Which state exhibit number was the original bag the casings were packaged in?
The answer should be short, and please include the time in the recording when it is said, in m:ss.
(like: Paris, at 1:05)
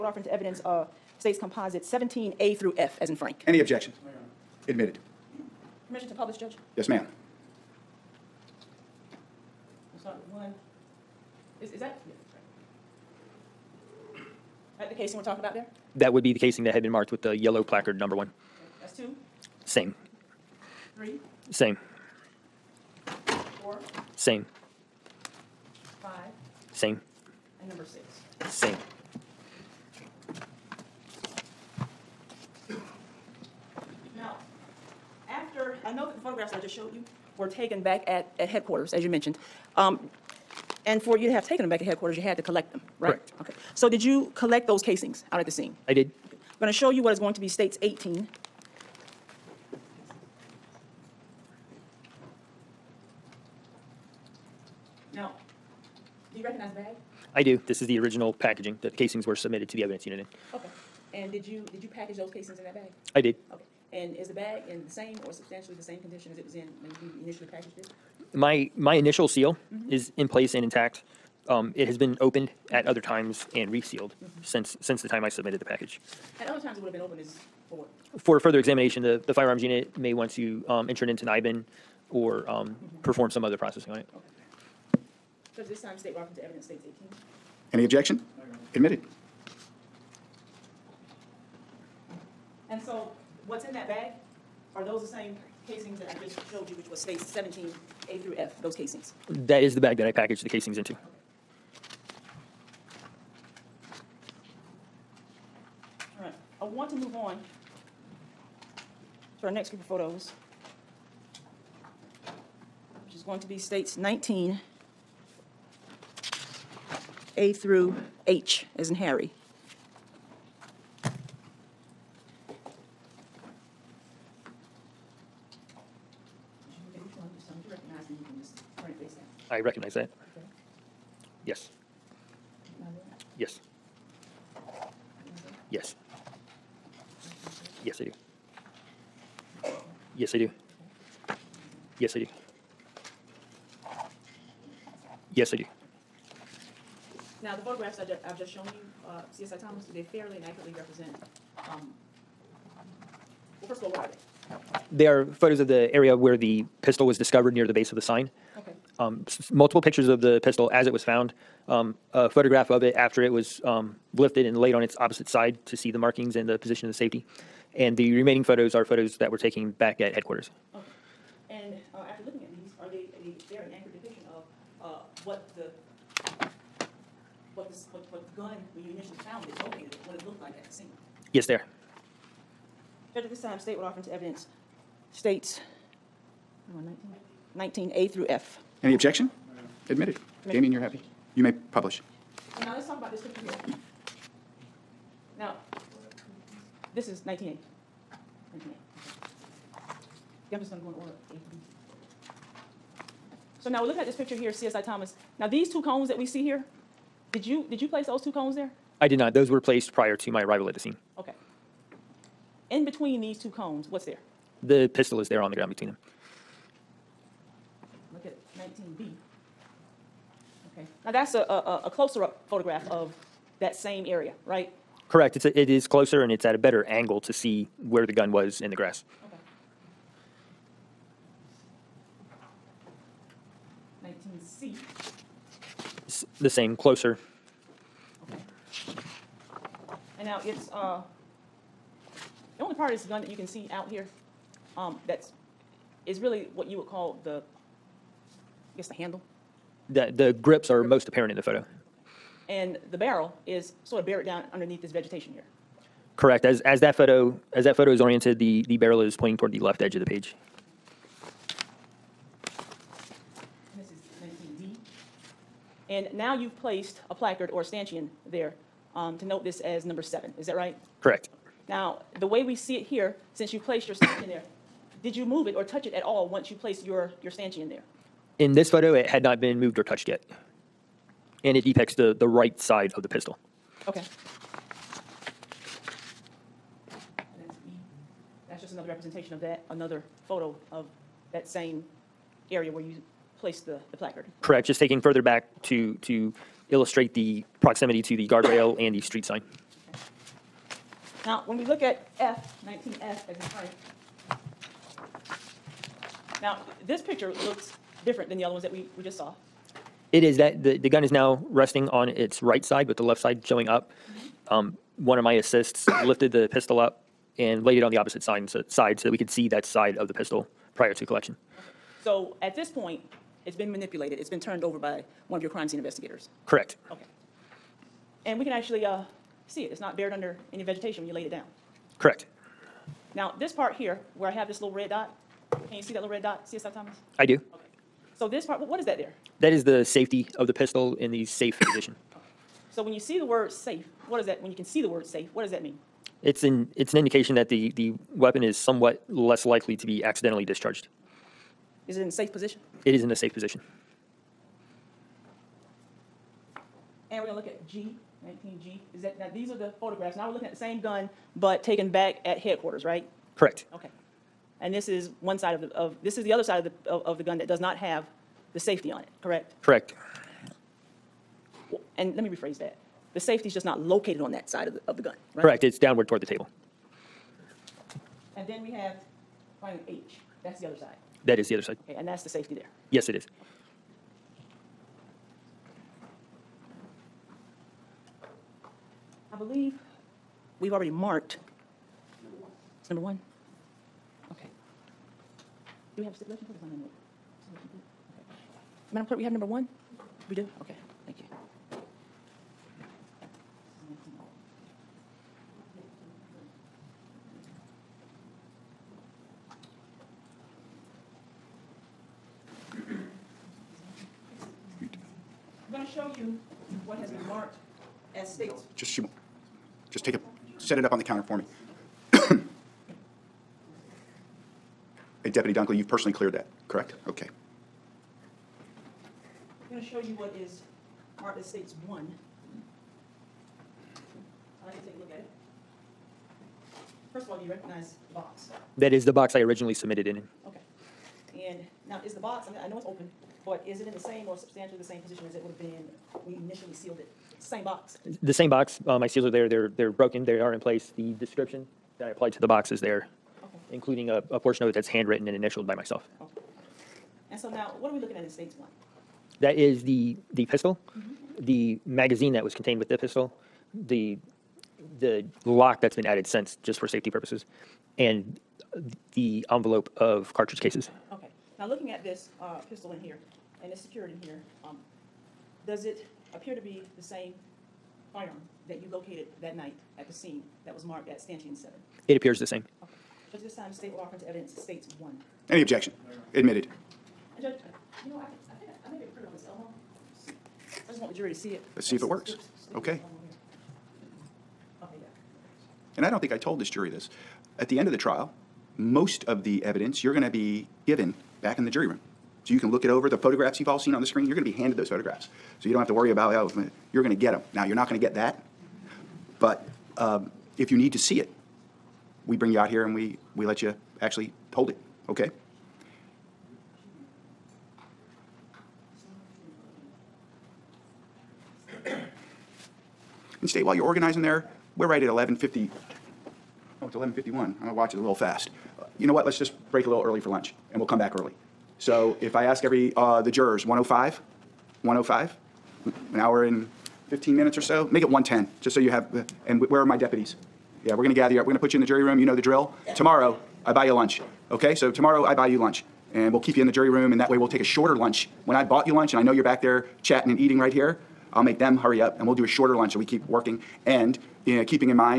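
18, at 0:47.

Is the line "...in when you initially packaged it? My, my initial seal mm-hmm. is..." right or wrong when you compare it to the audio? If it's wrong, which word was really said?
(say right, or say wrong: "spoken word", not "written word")
right.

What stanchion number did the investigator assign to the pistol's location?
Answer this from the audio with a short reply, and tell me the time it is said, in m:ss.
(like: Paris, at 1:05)
7, at 4:29.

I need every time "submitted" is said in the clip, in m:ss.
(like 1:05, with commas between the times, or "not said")
0:59, 1:15, 7:19.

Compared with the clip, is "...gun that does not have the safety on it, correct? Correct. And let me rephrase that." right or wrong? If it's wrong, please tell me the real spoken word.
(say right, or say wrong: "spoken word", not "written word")
right.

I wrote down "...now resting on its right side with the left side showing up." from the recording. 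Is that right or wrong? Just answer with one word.
right.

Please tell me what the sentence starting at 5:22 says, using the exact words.
So at this point, it's been manipulated.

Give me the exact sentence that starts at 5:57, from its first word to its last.
And we're gonna look at G, nineteen G.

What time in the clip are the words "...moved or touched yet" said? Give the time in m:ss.
4:39.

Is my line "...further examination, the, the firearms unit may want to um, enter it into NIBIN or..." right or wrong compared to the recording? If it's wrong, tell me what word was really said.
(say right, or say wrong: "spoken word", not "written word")
right.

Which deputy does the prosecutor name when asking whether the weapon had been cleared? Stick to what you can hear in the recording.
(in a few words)
Dunkley.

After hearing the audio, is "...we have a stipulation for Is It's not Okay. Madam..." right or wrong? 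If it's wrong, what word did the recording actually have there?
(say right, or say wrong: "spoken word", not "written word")
right.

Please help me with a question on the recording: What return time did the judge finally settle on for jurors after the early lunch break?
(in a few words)
1:10.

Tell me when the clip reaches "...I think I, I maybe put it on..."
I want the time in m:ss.
8:08.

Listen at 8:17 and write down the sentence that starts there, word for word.
At the end of the trial, most of the evidence you're going to be given back in the jury room.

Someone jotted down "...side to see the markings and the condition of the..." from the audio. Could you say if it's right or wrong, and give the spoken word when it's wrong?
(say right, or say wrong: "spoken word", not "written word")
wrong: "position", not "condition".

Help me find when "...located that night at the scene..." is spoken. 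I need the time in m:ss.
7:58.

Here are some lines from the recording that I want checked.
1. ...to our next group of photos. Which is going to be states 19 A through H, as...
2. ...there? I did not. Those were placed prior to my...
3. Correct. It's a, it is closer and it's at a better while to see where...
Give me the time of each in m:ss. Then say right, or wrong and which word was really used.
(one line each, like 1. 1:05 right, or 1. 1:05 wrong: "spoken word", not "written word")
1. 1:49 right
2. 3:28 right
3. 3:45 wrong: "angle", not "while".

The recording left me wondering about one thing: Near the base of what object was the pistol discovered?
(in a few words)
The sign.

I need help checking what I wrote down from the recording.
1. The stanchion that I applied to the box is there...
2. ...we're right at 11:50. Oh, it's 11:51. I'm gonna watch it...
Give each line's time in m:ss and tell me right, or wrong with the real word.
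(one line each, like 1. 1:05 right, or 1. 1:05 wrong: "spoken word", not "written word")
1. 7:30 wrong: "description", not "stanchion"
2. 8:44 right.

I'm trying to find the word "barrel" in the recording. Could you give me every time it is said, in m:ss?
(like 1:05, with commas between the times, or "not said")
4:12, 4:18.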